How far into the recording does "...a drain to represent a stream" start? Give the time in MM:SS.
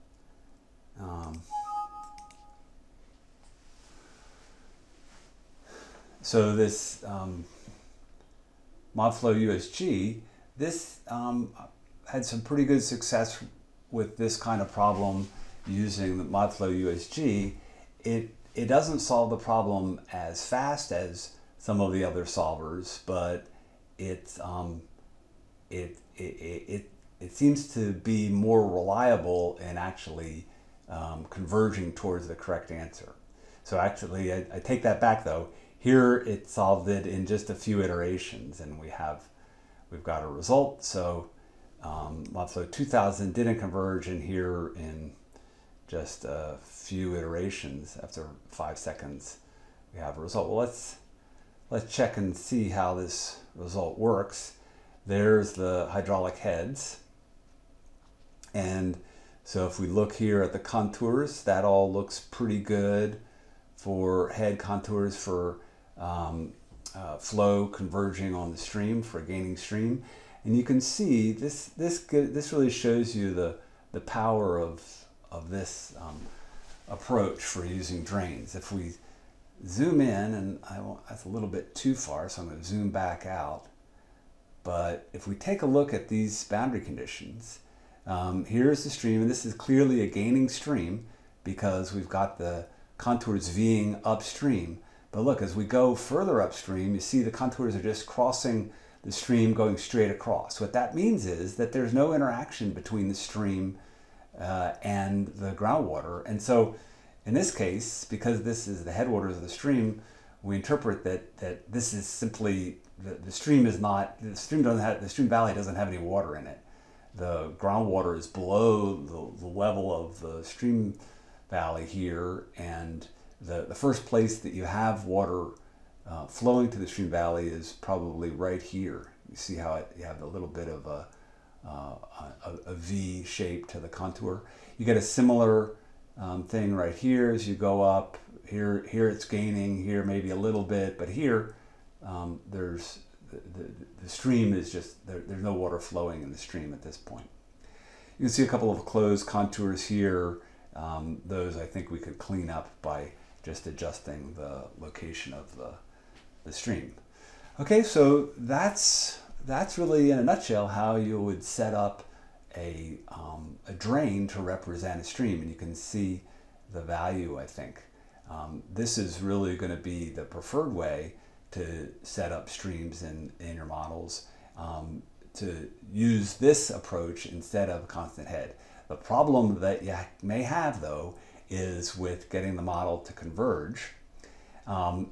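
02:43.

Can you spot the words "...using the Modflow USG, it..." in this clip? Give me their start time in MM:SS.
00:15.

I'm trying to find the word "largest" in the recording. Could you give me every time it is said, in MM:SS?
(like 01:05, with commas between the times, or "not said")
not said.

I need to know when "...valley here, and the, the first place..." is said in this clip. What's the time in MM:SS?
02:01.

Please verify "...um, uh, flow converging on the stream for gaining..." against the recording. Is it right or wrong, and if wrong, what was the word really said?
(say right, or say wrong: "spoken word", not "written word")
right.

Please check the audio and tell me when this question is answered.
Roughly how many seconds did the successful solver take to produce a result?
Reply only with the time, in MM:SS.
00:48.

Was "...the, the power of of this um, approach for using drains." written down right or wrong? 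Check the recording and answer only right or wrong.
right.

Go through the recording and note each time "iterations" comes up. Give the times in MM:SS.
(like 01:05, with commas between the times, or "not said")
00:37, 00:47.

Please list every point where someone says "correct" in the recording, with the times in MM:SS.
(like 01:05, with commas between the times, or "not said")
00:32.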